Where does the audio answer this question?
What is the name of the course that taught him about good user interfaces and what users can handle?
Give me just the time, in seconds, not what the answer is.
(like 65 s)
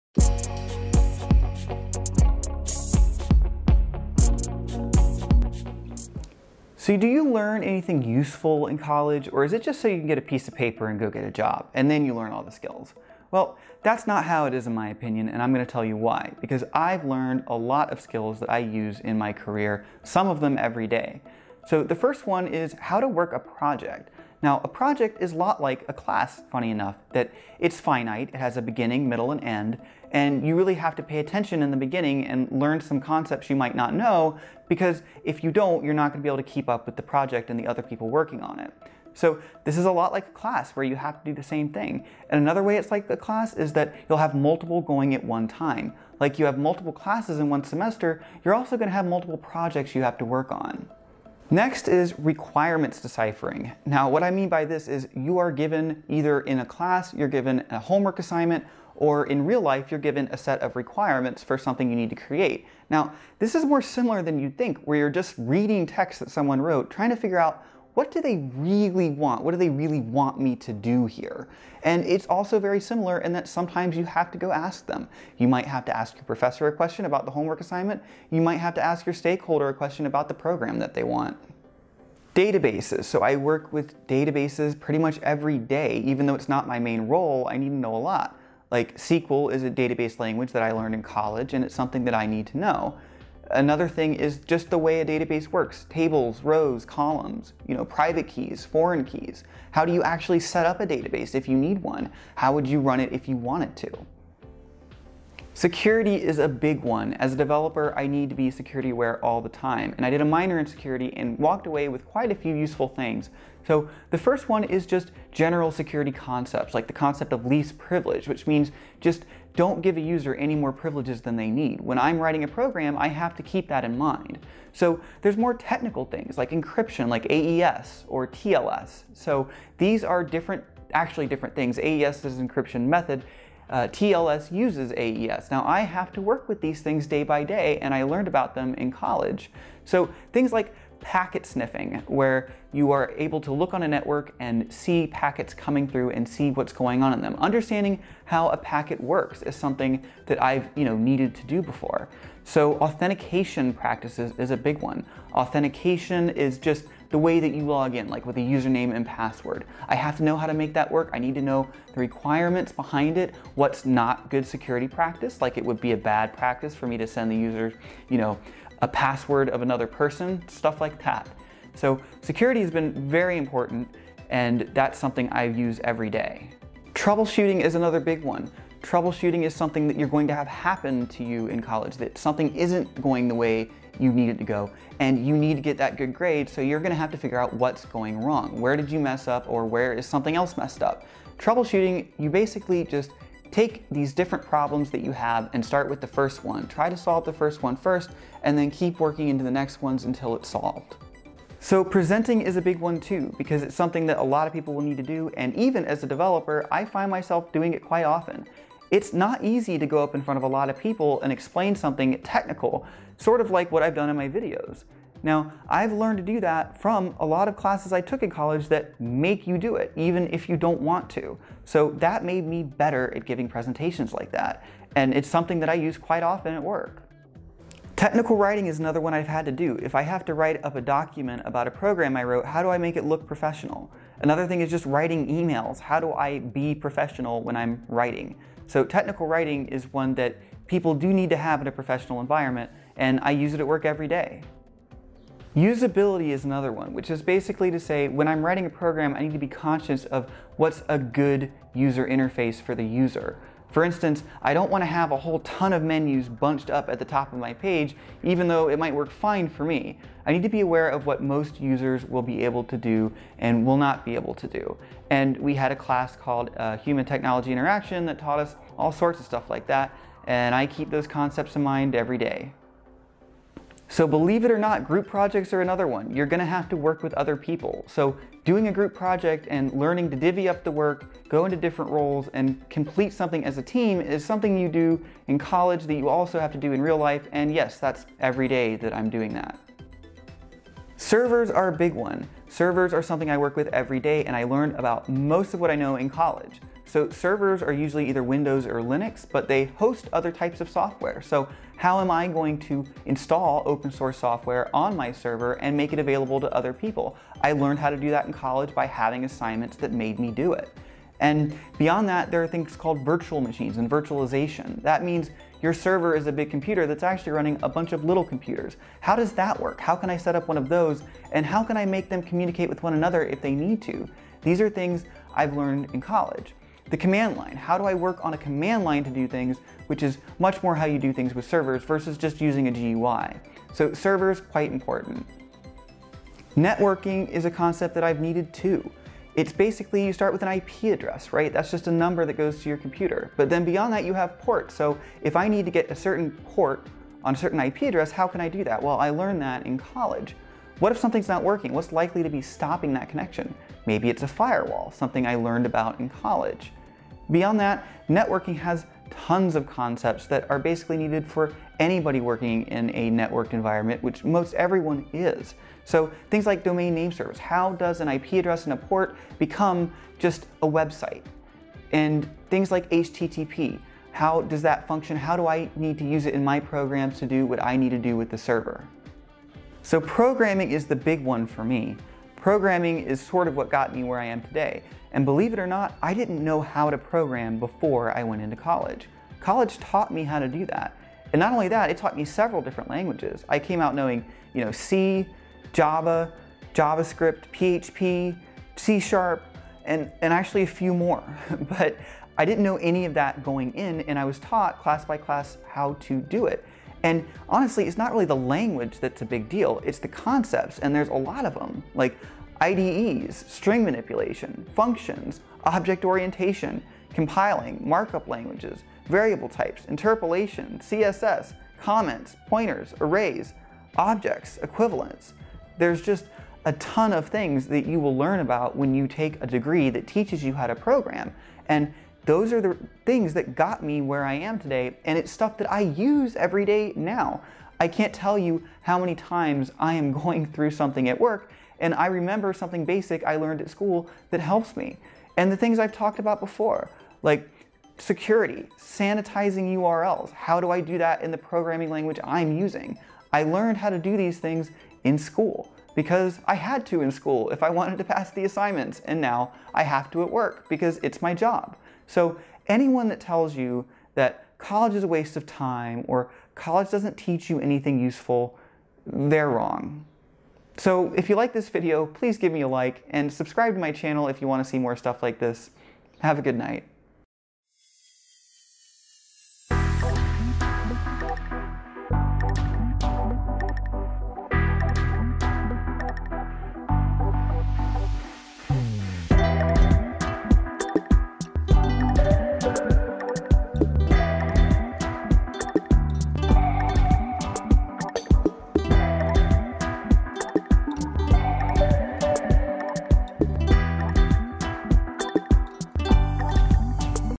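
266 s.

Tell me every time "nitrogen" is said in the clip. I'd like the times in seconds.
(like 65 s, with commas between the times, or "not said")
not said.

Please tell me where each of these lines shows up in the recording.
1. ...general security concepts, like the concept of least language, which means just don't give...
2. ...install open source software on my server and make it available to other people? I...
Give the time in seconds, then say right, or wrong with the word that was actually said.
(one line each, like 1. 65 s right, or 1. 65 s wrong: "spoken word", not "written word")
1. 115 s wrong: "privilege", not "language"
2. 303 s right.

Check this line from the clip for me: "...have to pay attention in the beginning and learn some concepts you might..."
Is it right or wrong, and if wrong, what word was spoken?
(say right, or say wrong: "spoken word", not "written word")
right.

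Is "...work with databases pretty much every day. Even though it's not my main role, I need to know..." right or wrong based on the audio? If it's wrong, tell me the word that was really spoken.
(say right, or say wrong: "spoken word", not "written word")
right.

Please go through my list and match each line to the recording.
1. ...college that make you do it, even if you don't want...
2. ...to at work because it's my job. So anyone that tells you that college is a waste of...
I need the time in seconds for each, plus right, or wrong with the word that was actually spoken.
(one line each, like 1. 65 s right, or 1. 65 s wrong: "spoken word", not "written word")
1. 218 s right
2. 460 s right.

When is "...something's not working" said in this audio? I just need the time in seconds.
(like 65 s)
350 s.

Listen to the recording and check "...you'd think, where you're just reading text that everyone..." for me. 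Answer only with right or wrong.
wrong.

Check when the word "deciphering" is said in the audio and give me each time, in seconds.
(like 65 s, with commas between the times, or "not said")
53 s.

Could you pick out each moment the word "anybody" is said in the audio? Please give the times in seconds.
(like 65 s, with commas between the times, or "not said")
361 s.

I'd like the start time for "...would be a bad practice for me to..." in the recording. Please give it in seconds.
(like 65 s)
165 s.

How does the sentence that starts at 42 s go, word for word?
And another way it's like a class is that you'll have multiple going at one time.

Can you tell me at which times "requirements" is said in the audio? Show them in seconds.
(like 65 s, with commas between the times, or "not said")
52 s, 60 s, 161 s.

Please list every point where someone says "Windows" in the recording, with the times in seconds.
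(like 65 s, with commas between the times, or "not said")
298 s.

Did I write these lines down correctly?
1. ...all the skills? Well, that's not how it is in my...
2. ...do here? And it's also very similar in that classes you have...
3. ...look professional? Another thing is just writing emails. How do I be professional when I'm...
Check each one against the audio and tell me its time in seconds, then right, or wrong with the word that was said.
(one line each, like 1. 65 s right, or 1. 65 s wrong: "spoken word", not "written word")
1. 12 s right
2. 70 s wrong: "sometimes", not "classes"
3. 233 s right.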